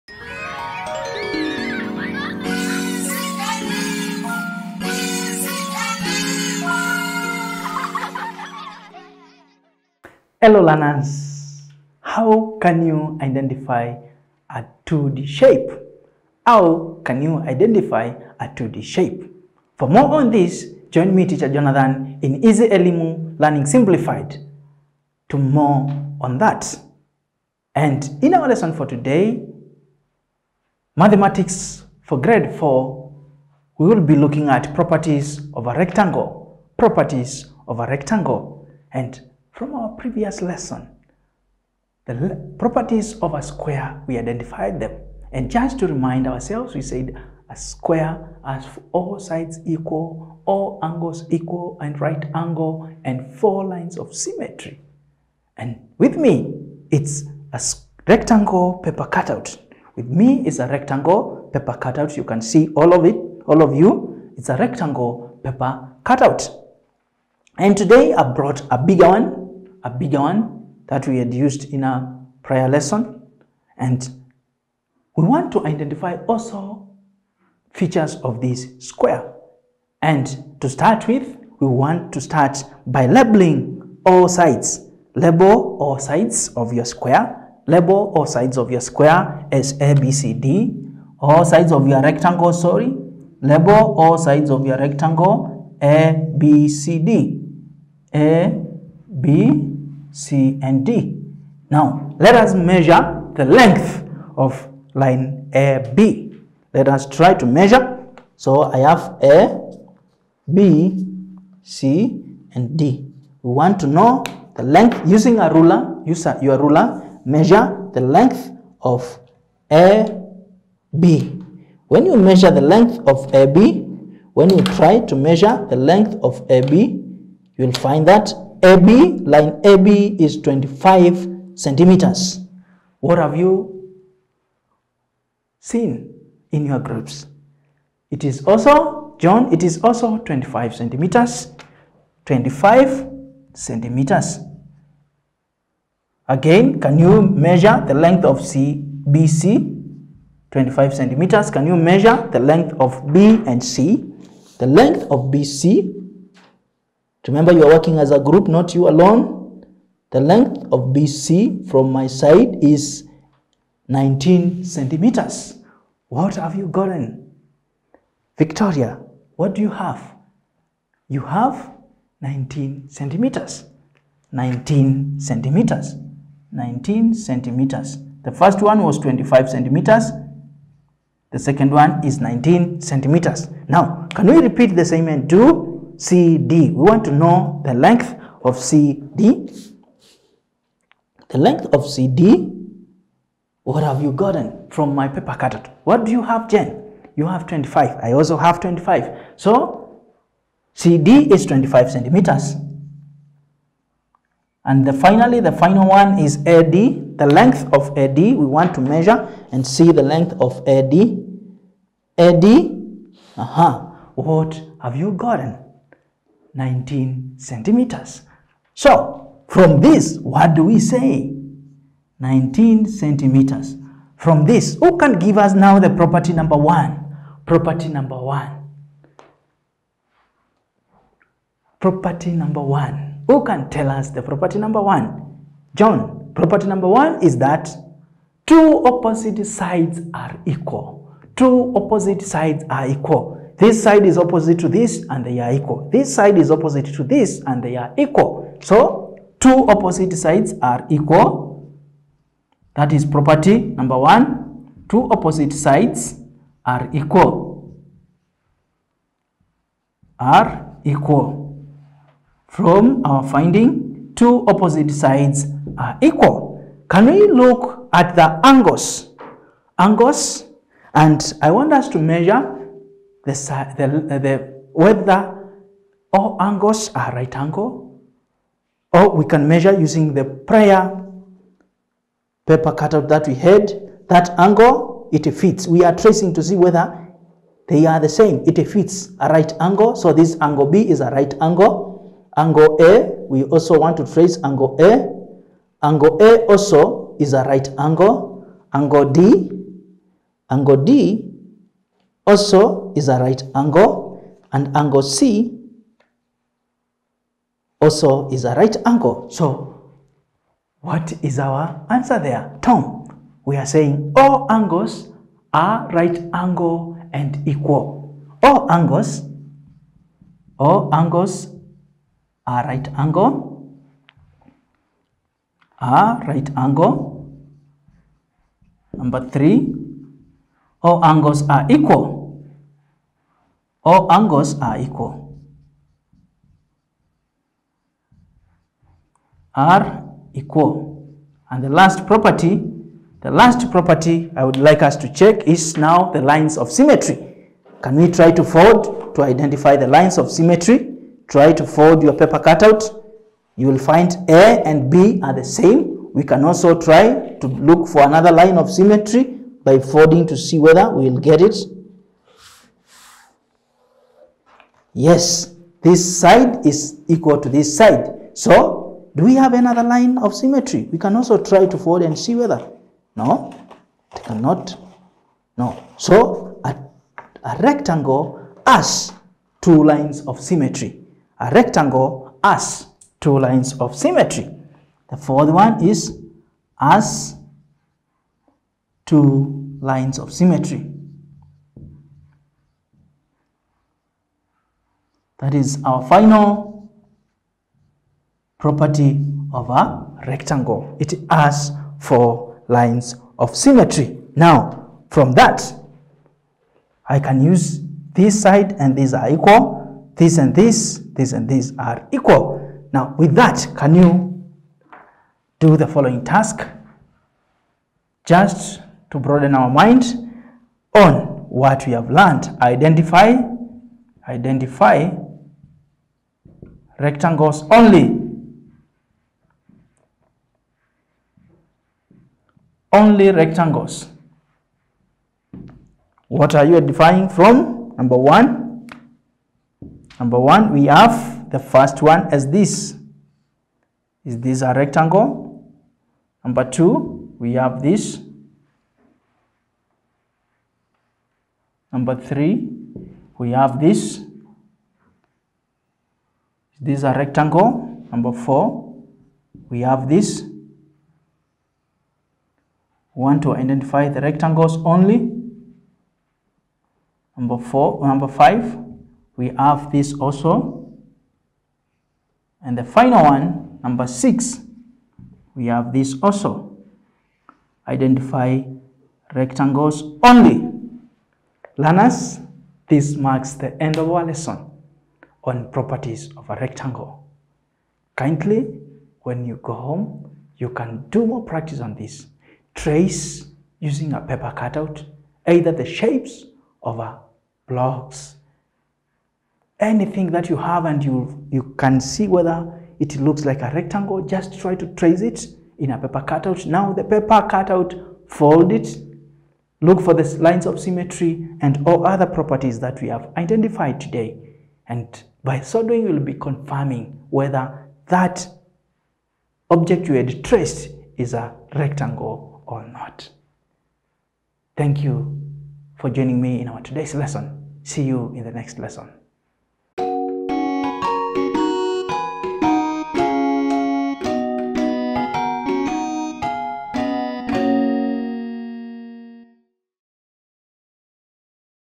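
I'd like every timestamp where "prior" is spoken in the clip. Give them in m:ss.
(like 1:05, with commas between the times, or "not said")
1:12.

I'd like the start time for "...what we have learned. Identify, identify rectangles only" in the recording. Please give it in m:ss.
7:01.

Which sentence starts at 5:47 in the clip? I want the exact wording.
Can we try to fold to identify the lines of symmetry?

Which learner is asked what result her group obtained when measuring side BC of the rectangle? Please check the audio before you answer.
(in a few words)
Victoria.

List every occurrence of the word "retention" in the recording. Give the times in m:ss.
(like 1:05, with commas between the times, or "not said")
not said.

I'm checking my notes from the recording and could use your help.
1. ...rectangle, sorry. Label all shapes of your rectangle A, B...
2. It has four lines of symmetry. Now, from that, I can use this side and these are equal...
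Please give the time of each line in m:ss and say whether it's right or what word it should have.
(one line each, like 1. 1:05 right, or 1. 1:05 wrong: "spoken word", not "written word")
1. 1:32 wrong: "sides", not "shapes"
2. 6:41 right.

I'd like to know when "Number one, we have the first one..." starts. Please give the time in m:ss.
7:20.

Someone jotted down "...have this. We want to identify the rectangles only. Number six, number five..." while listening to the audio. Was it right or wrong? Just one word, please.
wrong.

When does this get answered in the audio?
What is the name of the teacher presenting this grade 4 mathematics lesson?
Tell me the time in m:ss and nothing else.
0:21.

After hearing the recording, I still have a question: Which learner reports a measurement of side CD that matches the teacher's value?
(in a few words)
Jen.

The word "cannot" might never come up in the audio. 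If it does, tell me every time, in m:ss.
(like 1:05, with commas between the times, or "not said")
6:14.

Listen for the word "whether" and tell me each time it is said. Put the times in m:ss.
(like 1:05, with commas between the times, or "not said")
4:34, 4:46, 6:00, 6:12, 8:22, 8:37.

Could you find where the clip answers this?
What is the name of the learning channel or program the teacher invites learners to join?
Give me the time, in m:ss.
0:22.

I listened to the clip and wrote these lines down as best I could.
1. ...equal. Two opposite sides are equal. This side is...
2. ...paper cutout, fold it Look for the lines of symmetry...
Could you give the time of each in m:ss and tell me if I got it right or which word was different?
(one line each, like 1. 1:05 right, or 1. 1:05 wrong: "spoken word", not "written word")
1. 4:00 right
2. 8:27 right.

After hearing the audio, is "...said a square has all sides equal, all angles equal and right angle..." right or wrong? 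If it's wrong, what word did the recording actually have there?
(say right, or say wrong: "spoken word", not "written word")
right.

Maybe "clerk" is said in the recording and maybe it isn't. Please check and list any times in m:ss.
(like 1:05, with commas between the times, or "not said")
not said.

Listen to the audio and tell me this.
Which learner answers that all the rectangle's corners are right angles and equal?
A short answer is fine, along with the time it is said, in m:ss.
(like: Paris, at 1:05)
Tom, at 5:12.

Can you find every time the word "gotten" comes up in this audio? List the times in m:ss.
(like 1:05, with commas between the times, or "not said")
2:46, 3:14, 3:35.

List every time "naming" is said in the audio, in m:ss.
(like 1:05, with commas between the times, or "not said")
not said.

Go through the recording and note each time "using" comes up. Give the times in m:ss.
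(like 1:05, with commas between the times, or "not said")
1:55, 4:39, 8:13.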